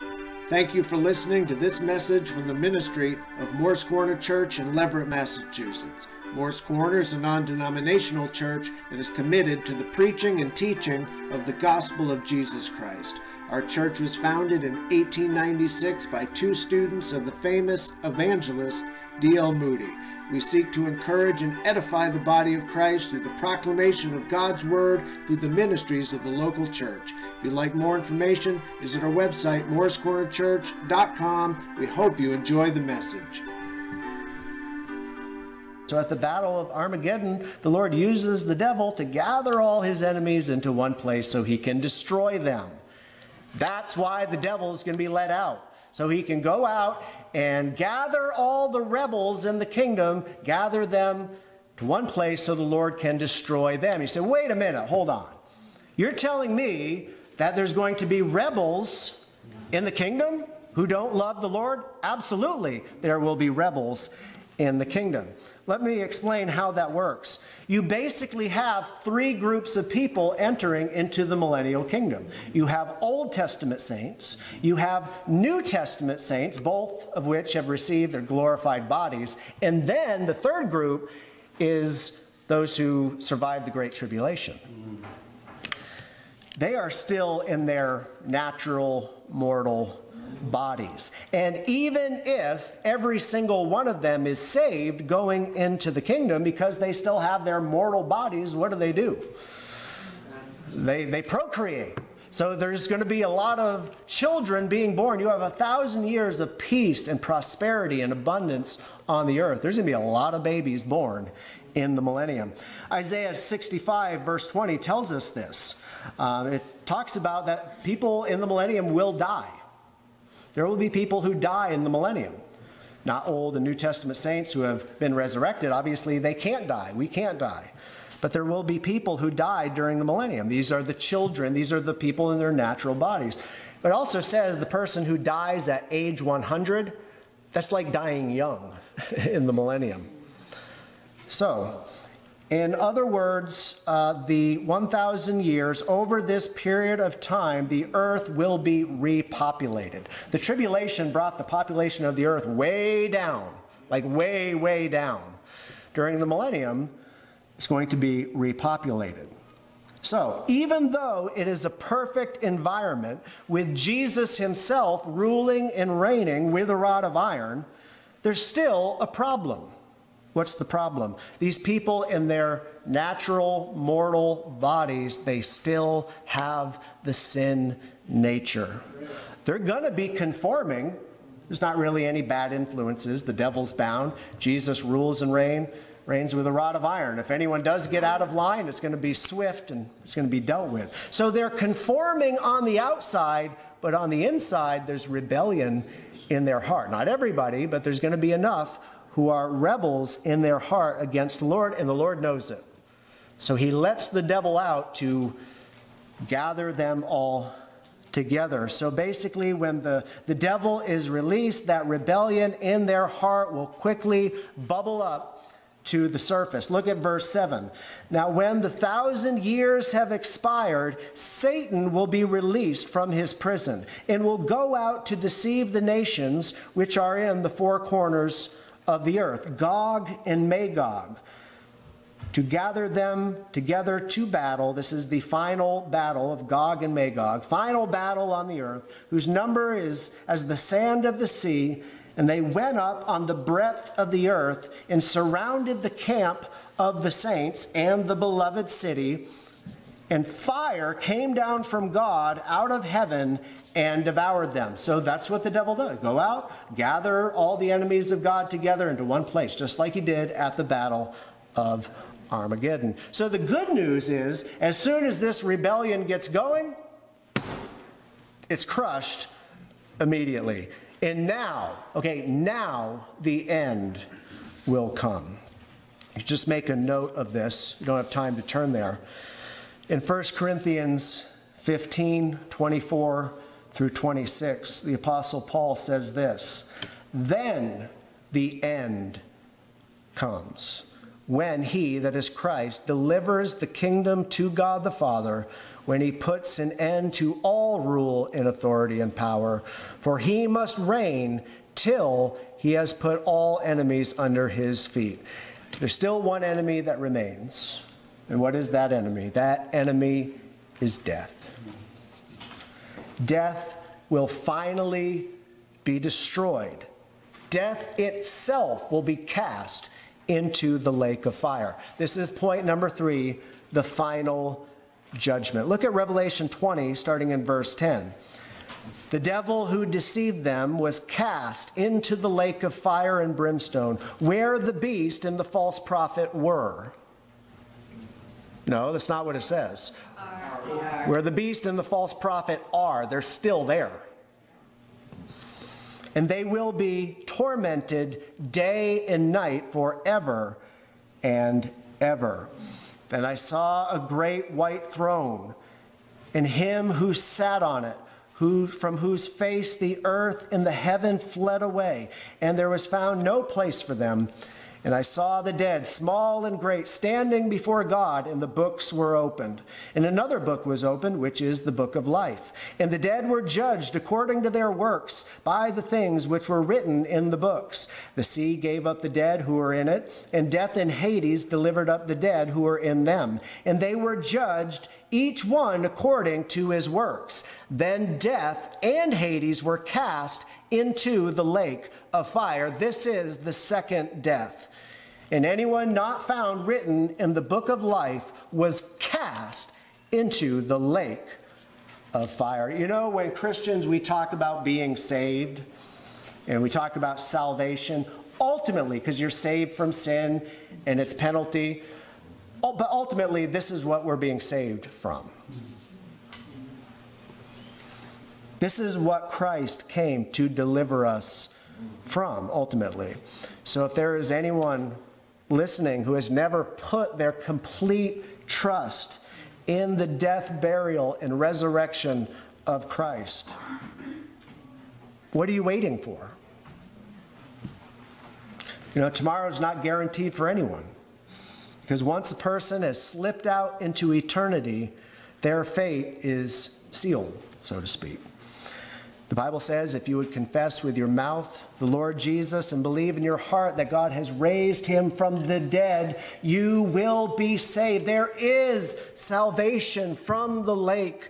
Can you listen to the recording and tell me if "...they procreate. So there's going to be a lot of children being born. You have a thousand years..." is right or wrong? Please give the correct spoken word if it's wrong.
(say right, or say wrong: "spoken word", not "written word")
right.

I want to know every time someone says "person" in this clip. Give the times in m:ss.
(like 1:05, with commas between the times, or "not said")
2:14, 7:22.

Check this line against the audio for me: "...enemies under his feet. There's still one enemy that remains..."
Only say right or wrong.
right.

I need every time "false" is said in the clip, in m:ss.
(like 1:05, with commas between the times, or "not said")
5:35, 5:41.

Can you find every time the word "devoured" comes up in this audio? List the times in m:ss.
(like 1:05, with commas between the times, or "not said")
4:14.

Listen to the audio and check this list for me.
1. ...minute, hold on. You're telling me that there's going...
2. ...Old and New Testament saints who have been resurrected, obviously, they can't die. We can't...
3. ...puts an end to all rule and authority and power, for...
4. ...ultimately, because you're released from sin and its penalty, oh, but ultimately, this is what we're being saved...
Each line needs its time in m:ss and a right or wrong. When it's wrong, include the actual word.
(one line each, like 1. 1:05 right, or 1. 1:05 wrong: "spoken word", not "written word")
1. 0:54 right
2. 2:03 right
3. 4:56 right
4. 6:48 wrong: "saved", not "released".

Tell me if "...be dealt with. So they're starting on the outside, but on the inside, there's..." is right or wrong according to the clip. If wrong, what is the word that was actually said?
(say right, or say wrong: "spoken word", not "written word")
wrong: "conforming", not "starting".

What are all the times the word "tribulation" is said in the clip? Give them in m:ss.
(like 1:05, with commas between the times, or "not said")
1:23, 2:30.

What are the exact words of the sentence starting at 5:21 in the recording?
This is point number three the final judgment.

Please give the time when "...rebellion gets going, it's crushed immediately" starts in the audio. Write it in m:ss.
4:25.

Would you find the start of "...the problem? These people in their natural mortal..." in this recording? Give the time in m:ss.
2:50.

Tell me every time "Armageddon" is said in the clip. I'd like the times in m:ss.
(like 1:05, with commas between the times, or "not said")
0:36, 4:22.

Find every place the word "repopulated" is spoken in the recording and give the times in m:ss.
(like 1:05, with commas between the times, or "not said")
2:28, 2:38.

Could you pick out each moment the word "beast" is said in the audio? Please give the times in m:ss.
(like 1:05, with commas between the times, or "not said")
5:34, 5:41.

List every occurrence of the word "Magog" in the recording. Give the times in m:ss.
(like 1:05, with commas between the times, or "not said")
3:50, 3:56.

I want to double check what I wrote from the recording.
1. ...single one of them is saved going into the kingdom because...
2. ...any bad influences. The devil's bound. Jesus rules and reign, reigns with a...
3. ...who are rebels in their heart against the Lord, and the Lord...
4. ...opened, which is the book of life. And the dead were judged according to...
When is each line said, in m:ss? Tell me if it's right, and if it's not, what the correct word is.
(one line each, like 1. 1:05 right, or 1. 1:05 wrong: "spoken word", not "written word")
1. 1:33 right
2. 3:02 right
3. 3:19 right
4. 6:10 right.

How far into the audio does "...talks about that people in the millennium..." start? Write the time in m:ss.
1:56.